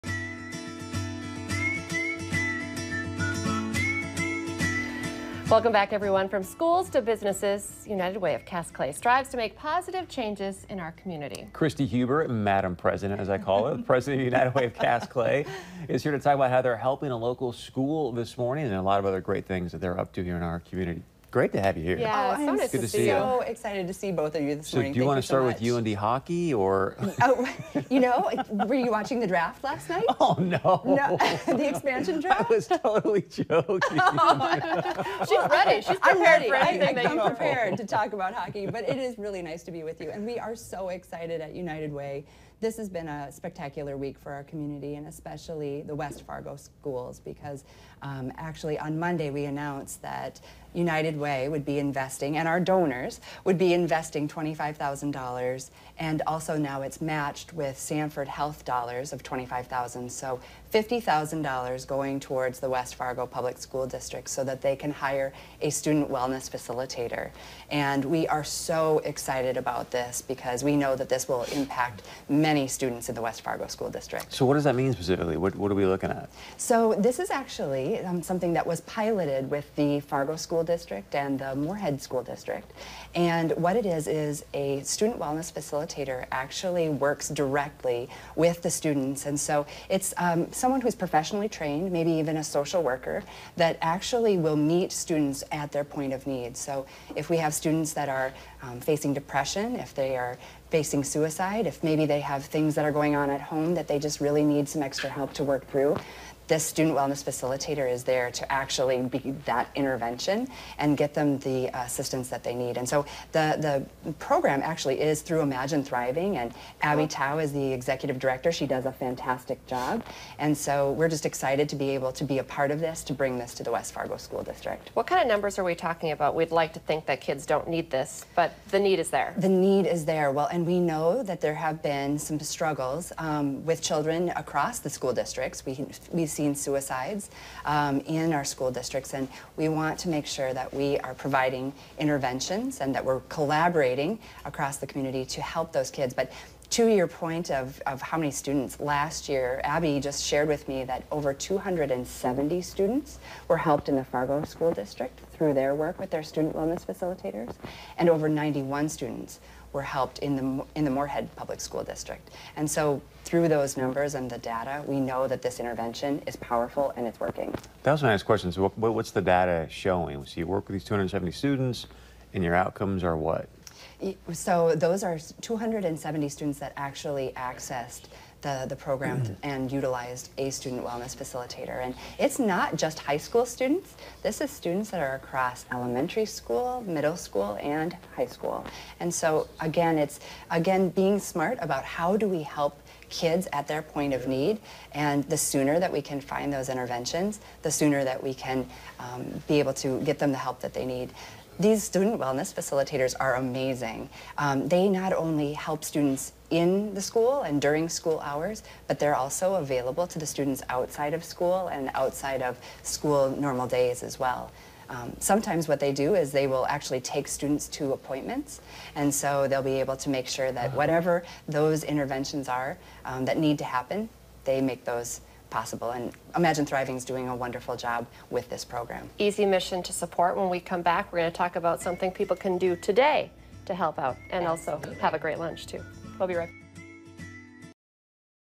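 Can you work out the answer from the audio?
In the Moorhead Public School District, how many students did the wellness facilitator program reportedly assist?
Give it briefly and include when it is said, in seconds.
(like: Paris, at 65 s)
91, at 158 s.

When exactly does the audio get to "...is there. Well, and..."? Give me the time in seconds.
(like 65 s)
129 s.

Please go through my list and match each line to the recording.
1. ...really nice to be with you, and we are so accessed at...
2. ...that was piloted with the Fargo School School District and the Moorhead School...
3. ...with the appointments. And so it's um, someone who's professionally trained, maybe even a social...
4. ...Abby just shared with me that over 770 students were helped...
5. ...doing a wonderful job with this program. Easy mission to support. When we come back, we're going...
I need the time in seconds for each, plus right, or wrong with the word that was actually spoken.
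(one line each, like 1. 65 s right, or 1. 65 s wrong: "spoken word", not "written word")
1. 39 s wrong: "excited", not "accessed"
2. 78 s right
3. 88 s wrong: "students", not "appointments"
4. 149 s wrong: "270", not "770"
5. 227 s right.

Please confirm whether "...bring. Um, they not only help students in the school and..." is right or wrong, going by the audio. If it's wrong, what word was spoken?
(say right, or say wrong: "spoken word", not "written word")
wrong: "amazing", not "bring".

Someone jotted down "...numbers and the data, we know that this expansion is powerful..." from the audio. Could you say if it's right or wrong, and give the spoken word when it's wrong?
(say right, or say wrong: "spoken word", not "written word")
wrong: "intervention", not "expansion".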